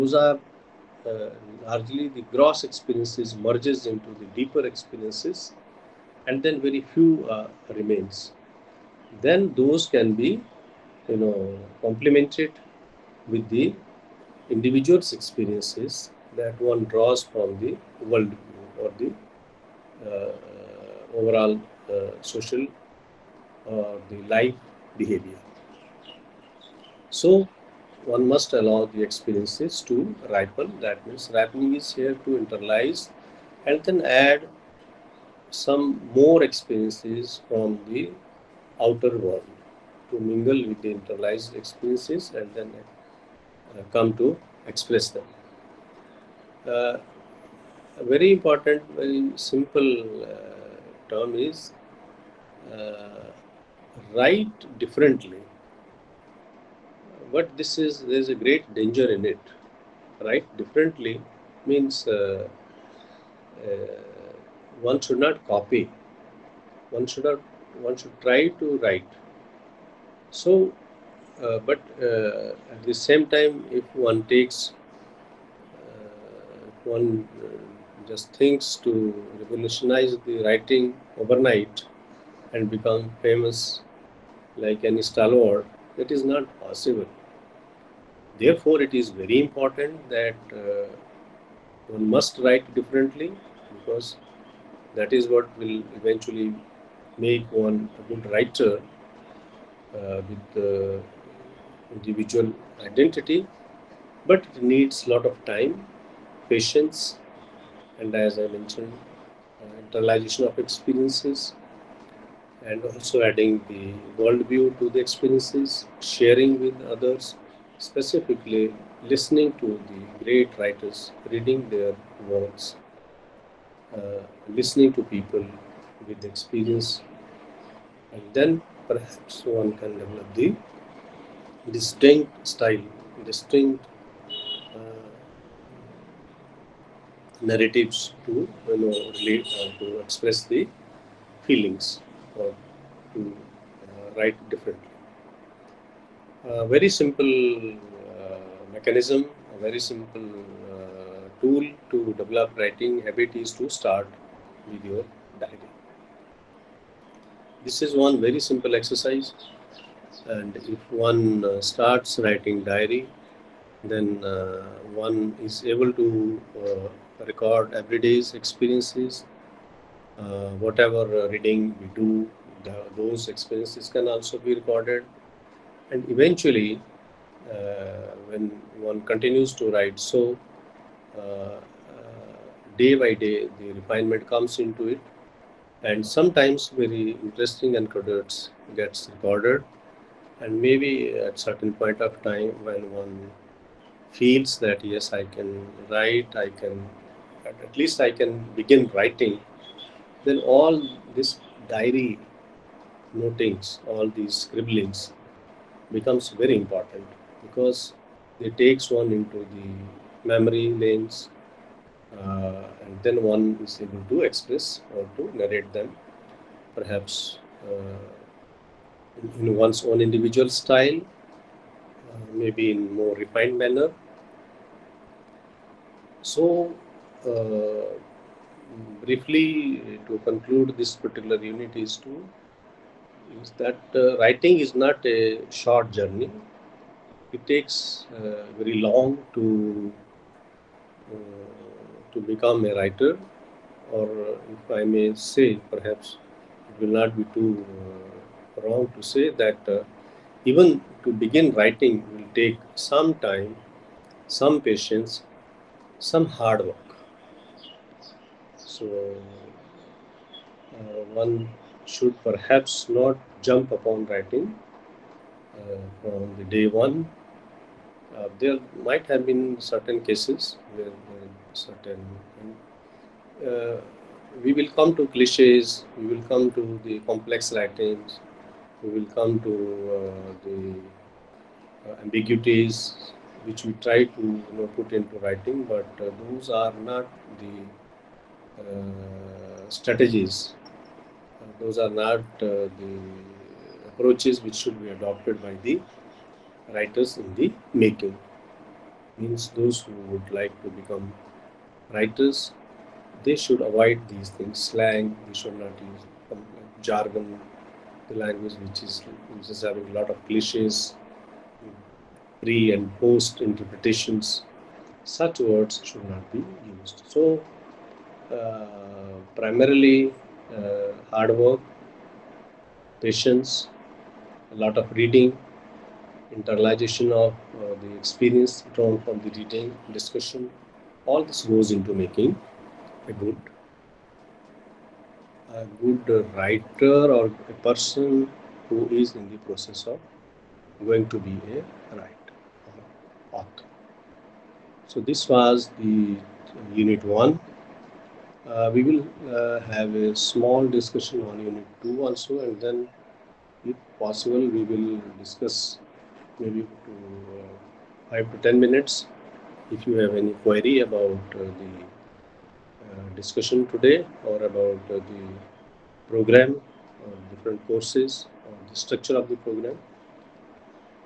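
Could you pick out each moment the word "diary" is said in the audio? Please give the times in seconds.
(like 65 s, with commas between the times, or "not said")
155 s, 162 s, 201 s.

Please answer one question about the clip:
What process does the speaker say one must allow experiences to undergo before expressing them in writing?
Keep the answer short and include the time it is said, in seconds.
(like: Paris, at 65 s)
Ripen, at 30 s.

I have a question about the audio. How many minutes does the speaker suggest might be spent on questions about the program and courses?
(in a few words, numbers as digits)
5 to 10 minutes.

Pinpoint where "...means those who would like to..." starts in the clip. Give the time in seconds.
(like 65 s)
299 s.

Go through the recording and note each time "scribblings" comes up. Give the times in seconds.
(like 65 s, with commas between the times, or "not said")
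204 s.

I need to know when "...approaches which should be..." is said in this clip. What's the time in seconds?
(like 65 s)
293 s.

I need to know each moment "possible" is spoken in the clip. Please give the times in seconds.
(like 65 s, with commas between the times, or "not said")
86 s, 353 s.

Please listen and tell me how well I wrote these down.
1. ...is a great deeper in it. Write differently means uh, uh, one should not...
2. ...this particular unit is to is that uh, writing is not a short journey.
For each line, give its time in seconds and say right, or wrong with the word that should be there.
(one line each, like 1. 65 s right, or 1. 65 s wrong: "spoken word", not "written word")
1. 58 s wrong: "danger", not "deeper"
2. 230 s right.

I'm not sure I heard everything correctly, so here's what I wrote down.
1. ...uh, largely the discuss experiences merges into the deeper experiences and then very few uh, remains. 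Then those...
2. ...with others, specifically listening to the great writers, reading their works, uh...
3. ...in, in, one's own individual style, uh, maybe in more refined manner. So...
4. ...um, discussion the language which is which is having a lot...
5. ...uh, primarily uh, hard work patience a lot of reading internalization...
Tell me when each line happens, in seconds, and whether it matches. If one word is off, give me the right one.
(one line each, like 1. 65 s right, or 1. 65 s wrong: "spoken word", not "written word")
1. 1 s wrong: "gross", not "discuss"
2. 116 s right
3. 219 s right
4. 306 s wrong: "jargon", not "discussion"
5. 318 s right.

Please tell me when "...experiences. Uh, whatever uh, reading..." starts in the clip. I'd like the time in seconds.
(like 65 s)
168 s.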